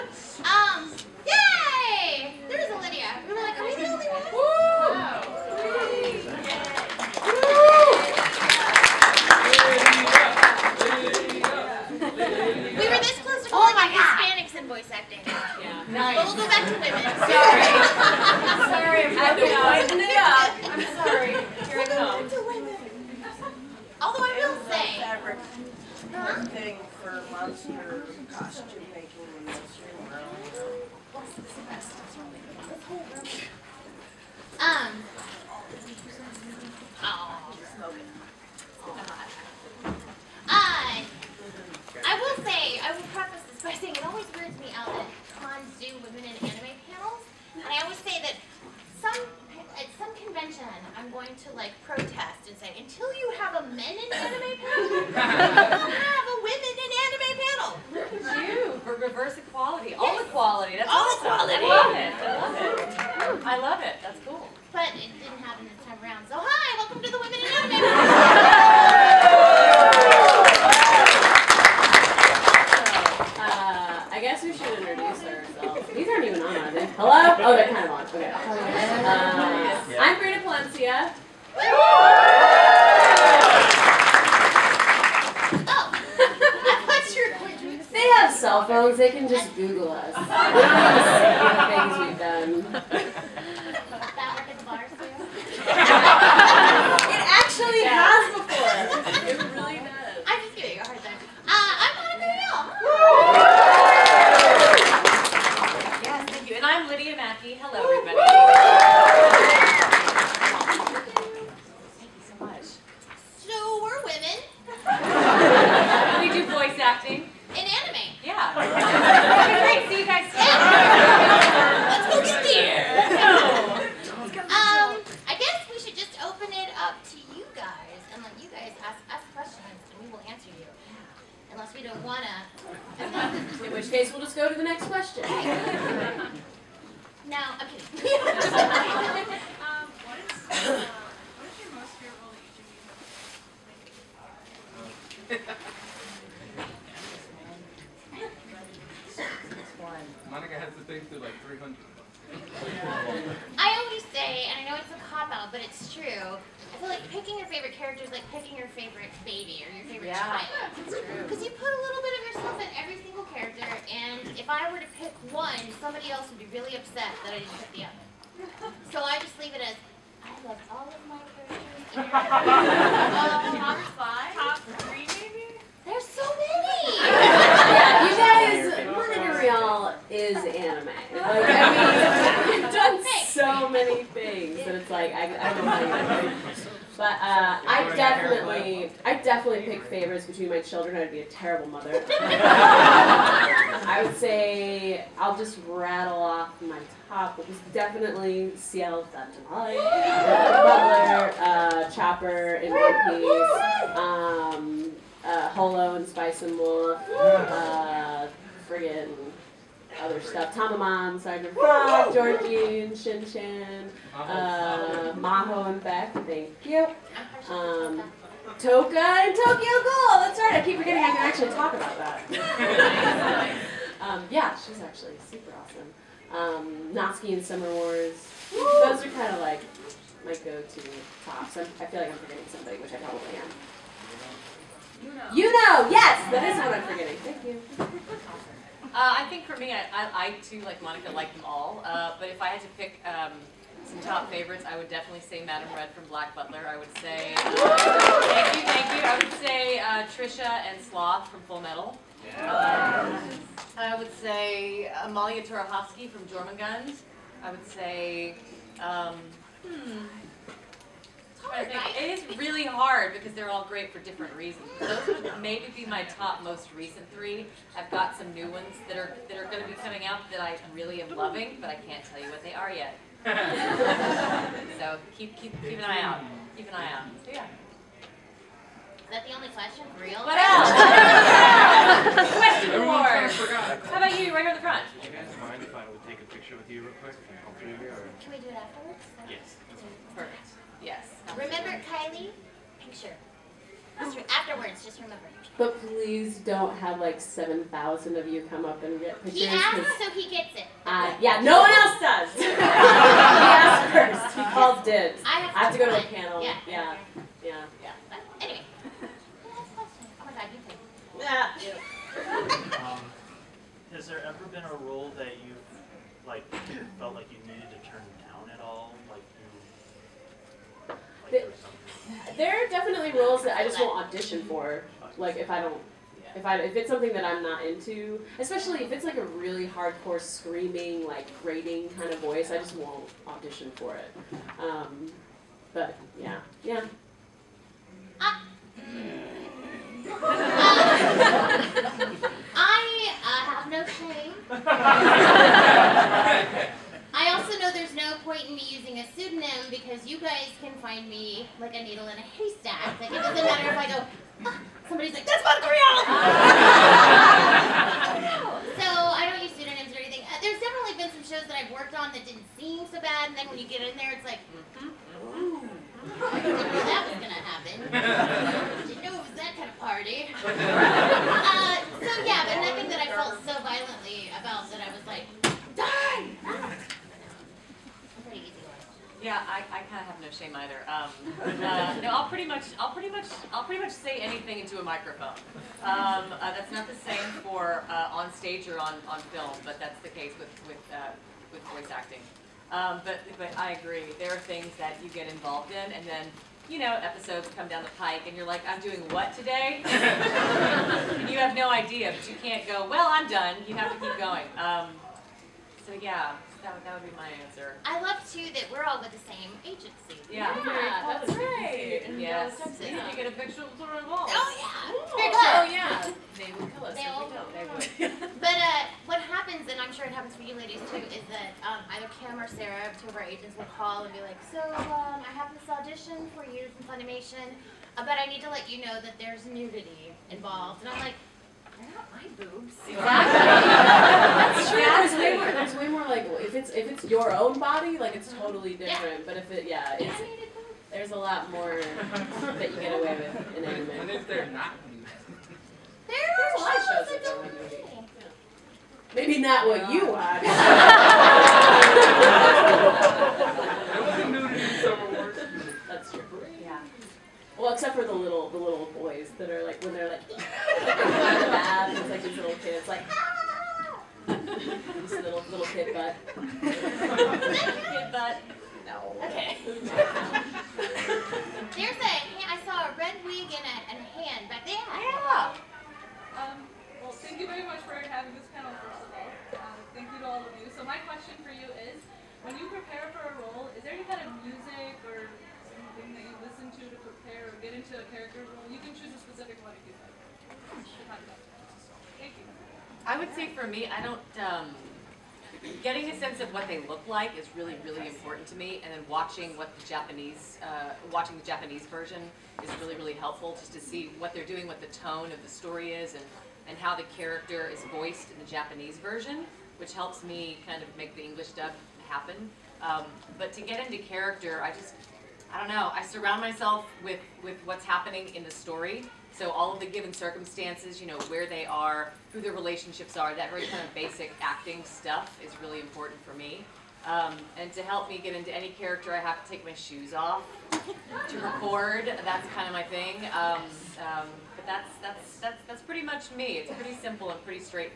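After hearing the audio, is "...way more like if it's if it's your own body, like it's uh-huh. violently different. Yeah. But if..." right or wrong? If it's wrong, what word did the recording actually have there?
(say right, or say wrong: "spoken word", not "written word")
wrong: "totally", not "violently".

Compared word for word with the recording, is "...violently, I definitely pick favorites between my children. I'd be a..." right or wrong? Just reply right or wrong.
wrong.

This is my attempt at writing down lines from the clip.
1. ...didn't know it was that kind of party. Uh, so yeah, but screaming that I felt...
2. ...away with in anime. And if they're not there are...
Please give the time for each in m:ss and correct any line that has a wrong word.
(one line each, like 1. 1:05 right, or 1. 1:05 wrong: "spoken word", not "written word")
1. 6:08 wrong: "nothing", not "screaming"
2. 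7:23 right.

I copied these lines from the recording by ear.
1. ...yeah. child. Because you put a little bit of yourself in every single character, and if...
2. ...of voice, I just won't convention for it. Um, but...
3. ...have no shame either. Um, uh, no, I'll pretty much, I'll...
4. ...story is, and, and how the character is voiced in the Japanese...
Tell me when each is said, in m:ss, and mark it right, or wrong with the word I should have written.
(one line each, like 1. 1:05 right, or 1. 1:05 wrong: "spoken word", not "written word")
1. 2:40 right
2. 5:32 wrong: "audition", not "convention"
3. 6:20 right
4. 8:25 right.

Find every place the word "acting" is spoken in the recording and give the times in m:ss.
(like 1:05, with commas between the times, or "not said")
6:31, 8:44.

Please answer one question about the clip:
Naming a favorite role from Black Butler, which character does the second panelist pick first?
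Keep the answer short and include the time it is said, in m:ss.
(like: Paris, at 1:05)
Madame Red, at 4:05.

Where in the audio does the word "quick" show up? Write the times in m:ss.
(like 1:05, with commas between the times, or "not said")
4:47.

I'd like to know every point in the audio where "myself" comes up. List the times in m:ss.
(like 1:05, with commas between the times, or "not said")
8:36.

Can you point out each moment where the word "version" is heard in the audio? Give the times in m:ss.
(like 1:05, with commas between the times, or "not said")
8:21, 8:28.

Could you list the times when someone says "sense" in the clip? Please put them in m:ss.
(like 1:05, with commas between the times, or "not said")
8:16.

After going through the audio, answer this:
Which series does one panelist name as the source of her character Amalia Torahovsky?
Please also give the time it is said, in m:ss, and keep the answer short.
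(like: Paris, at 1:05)
Jormungand, at 4:16.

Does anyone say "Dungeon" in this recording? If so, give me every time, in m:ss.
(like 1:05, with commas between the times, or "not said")
3:19.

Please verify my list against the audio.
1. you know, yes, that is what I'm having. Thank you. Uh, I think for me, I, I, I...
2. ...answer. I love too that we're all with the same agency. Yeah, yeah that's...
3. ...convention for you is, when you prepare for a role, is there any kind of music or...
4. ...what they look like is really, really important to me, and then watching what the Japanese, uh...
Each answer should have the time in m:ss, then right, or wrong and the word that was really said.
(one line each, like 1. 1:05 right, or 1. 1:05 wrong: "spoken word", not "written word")
1. 3:55 wrong: "forgetting", not "having"
2. 6:47 right
3. 8:01 wrong: "question", not "convention"
4. 8:16 right.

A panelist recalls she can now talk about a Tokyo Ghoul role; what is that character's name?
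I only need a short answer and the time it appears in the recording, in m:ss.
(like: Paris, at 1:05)
Toka, at 3:38.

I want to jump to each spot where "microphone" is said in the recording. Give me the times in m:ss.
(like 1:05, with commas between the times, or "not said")
6:24.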